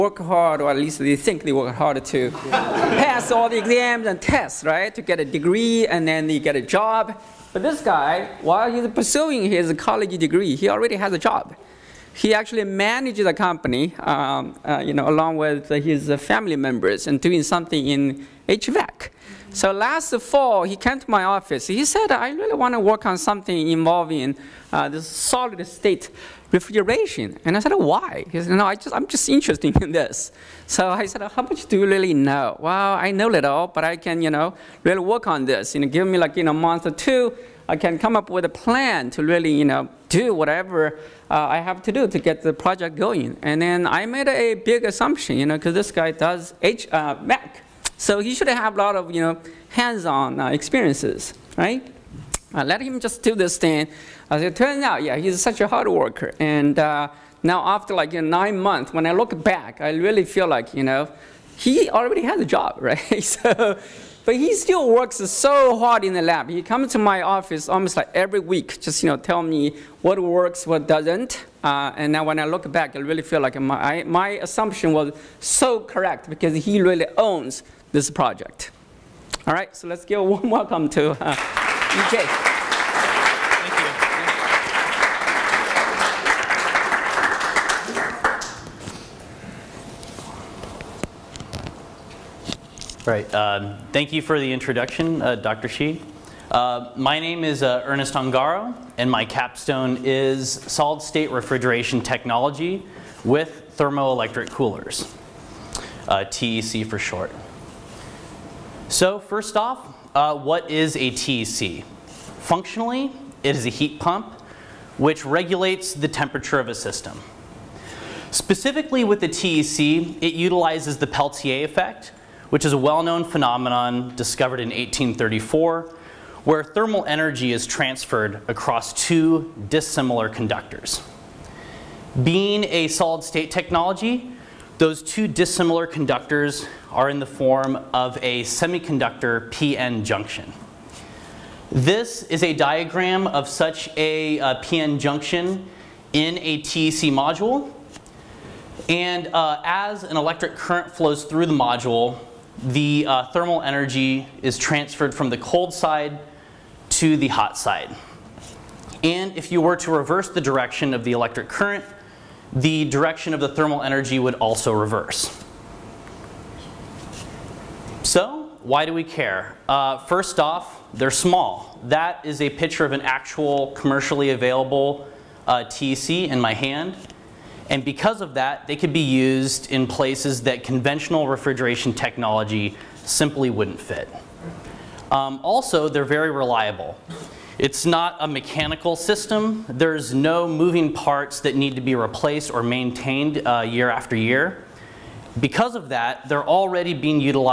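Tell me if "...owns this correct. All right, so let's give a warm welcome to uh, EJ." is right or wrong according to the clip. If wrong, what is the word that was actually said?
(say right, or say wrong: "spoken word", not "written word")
wrong: "project", not "correct".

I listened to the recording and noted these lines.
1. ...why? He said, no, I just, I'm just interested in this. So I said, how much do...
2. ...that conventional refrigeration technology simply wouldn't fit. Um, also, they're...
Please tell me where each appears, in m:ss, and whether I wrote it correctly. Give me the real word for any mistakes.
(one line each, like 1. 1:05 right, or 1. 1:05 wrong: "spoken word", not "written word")
1. 0:27 right
2. 3:00 right.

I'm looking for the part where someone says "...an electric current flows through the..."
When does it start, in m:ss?
2:30.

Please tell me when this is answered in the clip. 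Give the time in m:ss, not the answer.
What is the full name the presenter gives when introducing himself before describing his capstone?
1:37.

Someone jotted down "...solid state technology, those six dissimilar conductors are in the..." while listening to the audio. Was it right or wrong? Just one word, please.
wrong.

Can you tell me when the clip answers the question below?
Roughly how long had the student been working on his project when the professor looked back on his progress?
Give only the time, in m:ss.
0:58.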